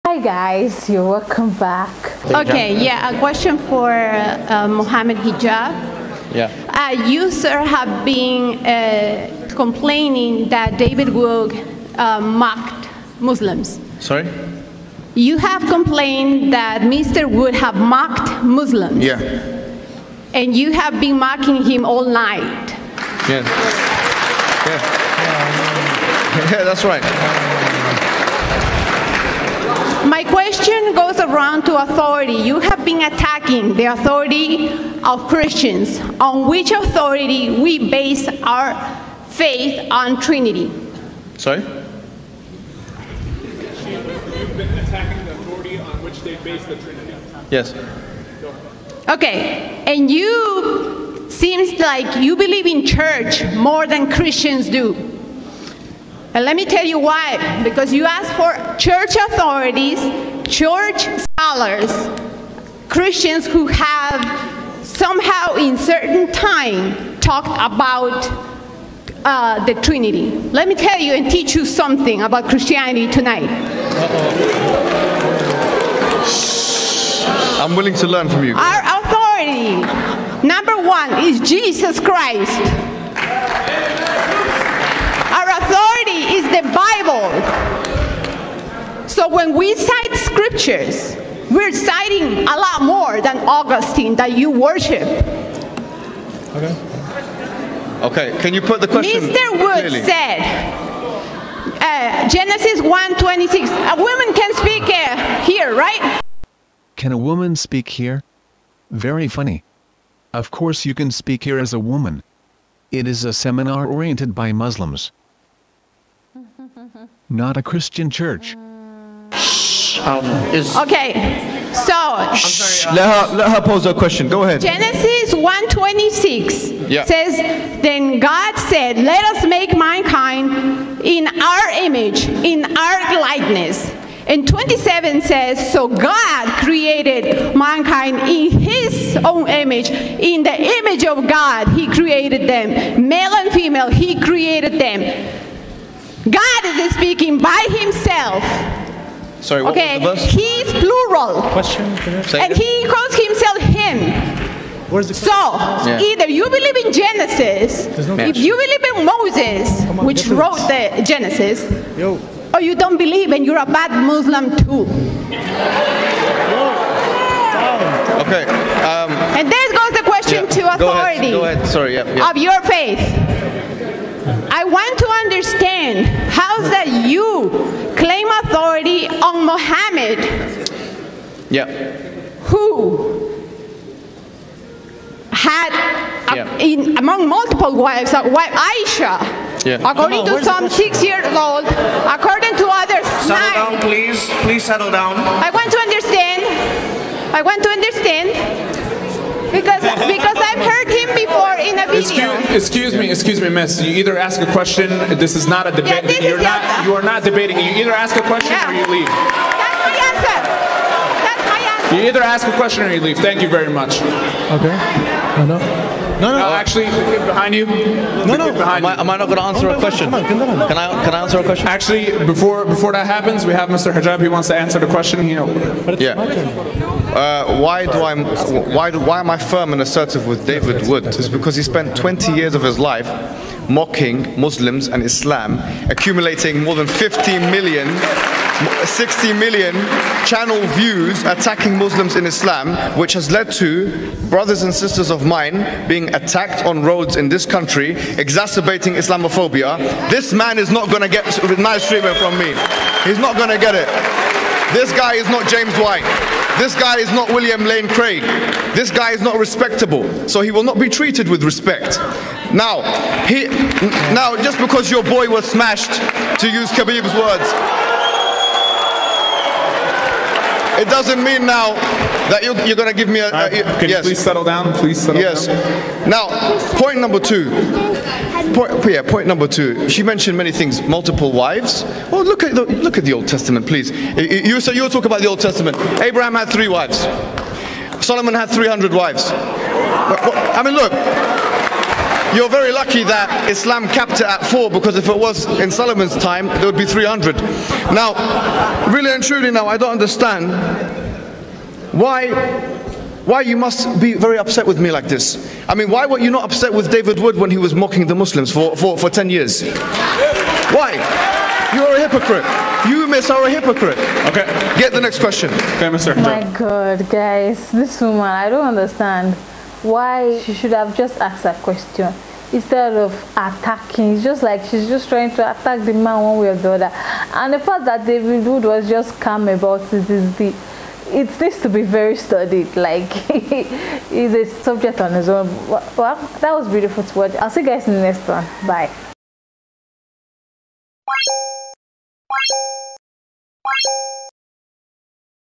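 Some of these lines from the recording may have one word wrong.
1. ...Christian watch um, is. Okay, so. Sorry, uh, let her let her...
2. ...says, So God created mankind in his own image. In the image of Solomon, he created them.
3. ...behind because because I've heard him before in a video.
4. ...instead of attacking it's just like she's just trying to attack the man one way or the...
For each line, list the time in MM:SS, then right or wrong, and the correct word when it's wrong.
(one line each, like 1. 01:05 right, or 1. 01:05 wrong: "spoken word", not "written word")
1. 01:57 wrong: "church", not "watch"
2. 02:15 wrong: "God", not "Solomon"
3. 03:17 wrong: "understand", not "behind"
4. 05:22 right.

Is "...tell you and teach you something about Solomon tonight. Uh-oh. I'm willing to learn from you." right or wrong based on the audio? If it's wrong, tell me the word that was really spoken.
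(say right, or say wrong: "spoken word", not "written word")
wrong: "Christianity", not "Solomon".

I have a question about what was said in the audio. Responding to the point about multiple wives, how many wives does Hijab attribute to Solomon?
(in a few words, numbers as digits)
300.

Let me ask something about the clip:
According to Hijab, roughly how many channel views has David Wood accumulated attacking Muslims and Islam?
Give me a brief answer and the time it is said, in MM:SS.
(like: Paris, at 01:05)
60 million, at 03:58.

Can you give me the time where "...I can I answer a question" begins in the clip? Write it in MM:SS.
03:40.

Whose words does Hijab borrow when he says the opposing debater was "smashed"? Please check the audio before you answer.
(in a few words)
Khabib.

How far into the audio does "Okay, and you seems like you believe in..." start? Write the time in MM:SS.
00:49.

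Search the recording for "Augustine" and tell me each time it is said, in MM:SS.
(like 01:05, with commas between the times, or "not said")
01:33.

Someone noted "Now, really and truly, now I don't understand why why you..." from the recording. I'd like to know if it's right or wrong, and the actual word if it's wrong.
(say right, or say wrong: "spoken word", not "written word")
right.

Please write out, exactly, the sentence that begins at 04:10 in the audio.
This man is not going to get nice treatment from me.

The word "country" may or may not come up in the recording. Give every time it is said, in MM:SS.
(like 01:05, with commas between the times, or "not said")
04:07.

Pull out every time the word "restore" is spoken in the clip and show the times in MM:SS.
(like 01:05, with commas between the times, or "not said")
not said.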